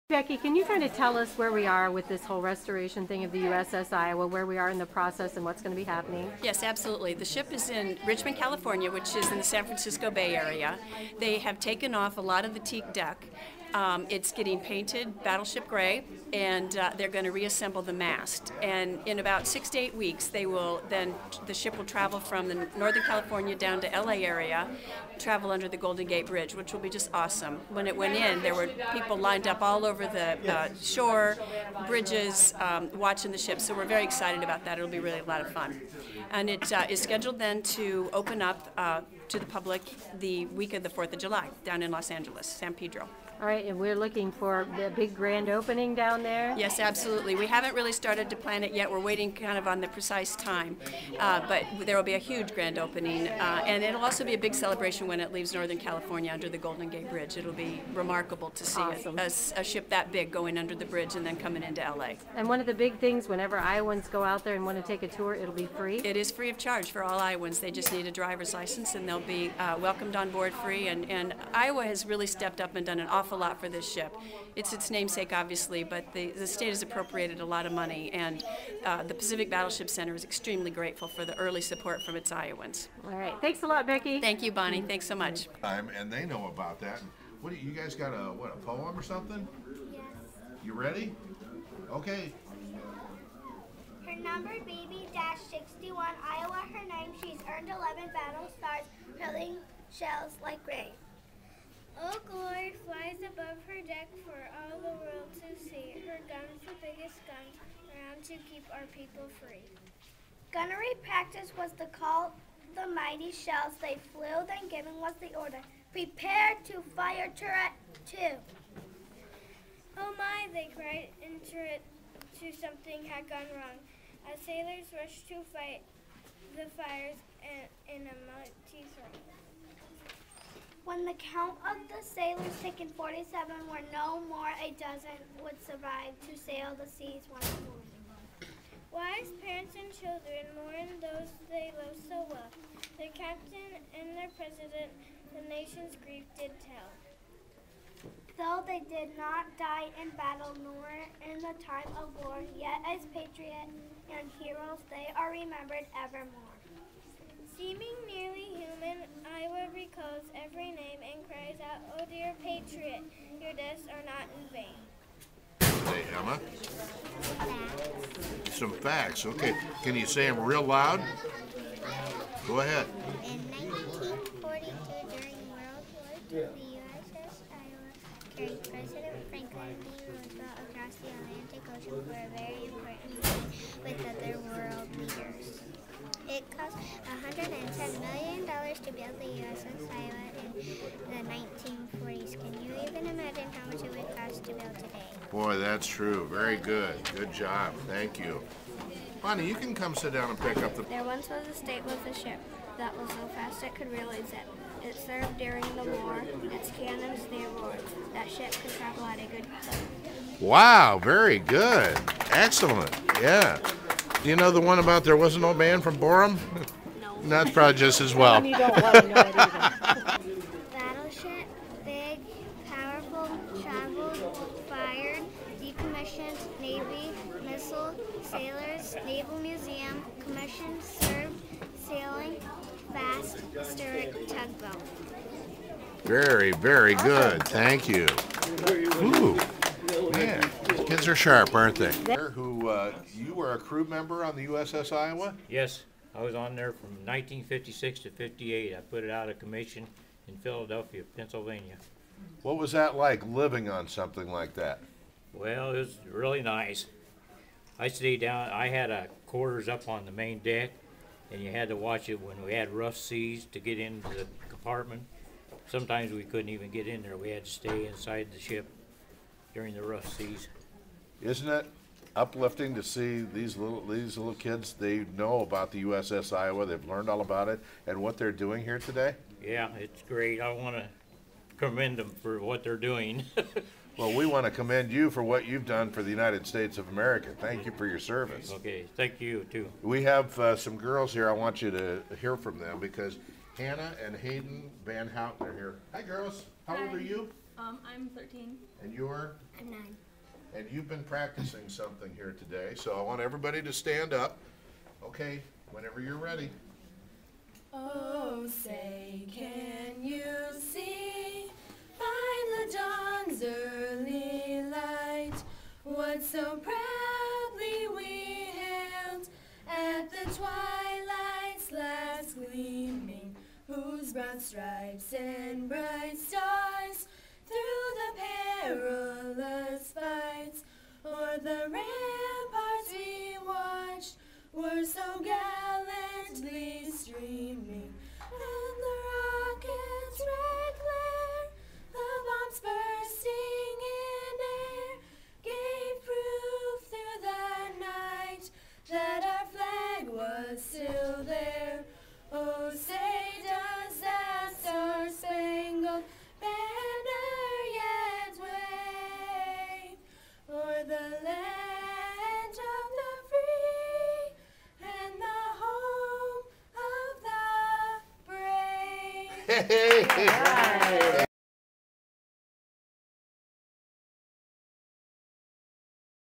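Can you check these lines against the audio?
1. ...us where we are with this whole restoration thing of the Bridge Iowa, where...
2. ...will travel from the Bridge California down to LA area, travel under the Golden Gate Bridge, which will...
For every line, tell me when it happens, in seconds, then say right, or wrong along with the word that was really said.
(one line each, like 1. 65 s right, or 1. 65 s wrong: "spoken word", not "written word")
1. 1 s wrong: "USS", not "Bridge"
2. 21 s wrong: "Northern", not "Bridge".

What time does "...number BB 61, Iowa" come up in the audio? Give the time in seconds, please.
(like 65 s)
94 s.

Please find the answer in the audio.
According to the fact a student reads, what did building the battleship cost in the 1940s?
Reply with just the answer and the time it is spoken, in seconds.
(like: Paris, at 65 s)
$110 million, at 187 s.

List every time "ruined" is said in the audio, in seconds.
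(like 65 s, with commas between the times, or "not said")
not said.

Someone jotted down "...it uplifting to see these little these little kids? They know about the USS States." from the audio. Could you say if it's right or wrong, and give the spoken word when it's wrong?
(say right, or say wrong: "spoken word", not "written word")
wrong: "Iowa", not "States".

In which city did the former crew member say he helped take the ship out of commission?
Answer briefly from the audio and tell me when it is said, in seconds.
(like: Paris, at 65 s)
Philadelphia, at 250 s.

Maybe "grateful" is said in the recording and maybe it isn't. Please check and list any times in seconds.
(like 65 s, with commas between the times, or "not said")
80 s.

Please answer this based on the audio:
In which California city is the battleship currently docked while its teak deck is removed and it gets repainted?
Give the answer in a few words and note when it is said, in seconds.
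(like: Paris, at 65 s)
Richmond, at 8 s.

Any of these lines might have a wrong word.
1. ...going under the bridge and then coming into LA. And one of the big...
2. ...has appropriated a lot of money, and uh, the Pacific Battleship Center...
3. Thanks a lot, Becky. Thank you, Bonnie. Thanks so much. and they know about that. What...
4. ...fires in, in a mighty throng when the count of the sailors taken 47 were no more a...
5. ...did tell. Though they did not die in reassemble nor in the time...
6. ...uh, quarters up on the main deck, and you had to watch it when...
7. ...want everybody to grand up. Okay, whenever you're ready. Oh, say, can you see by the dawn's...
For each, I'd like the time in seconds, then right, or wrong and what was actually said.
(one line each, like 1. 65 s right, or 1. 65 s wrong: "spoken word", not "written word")
1. 60 s right
2. 76 s right
3. 83 s right
4. 126 s right
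5. 146 s wrong: "battle", not "reassemble"
6. 258 s right
7. 303 s wrong: "stand", not "grand".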